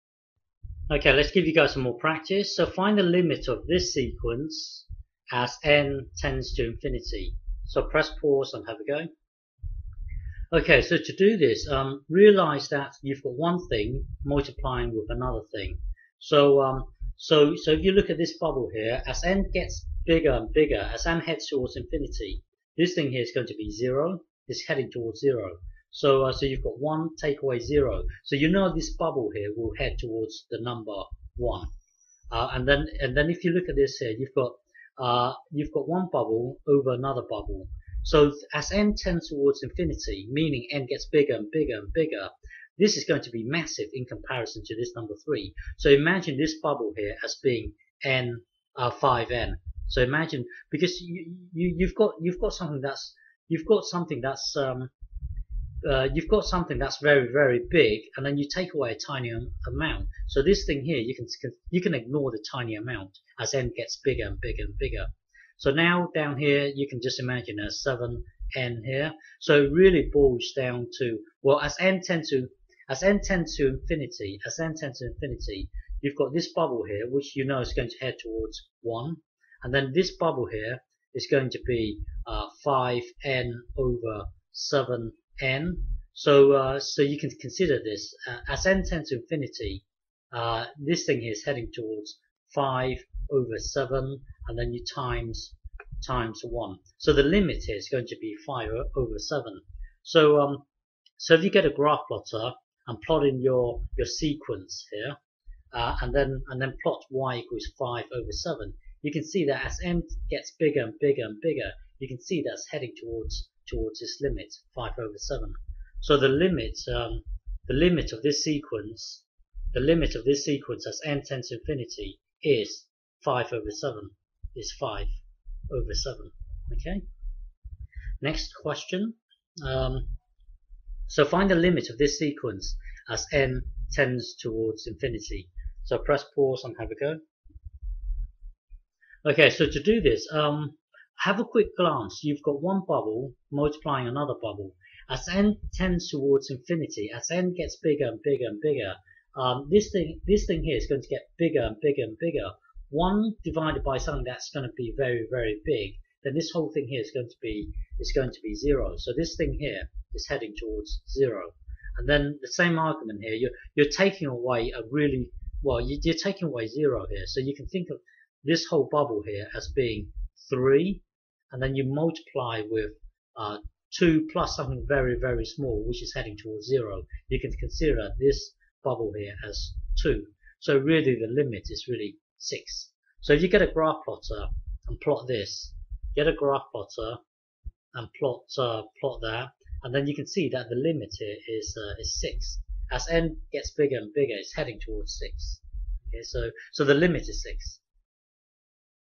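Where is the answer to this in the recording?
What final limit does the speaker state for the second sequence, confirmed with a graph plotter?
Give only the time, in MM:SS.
03:16.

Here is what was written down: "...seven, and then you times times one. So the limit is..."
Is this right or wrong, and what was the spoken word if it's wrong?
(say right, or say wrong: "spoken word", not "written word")
right.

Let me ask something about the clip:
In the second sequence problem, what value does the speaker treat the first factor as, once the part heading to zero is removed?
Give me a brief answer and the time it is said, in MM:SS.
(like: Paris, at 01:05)
3, at 02:50.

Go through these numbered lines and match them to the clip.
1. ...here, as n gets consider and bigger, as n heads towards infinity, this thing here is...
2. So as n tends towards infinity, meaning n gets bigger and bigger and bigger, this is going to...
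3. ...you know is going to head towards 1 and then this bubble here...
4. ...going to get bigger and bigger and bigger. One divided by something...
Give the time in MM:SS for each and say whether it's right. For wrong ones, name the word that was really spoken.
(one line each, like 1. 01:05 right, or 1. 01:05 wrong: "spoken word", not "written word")
1. 00:18 wrong: "bigger", not "consider"
2. 00:38 right
3. 01:17 right
4. 02:30 right.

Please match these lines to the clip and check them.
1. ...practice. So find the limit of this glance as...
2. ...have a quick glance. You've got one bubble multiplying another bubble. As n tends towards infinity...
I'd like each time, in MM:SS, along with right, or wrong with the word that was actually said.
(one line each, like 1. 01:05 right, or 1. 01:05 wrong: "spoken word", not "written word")
1. 00:01 wrong: "sequence", not "glance"
2. 02:21 right.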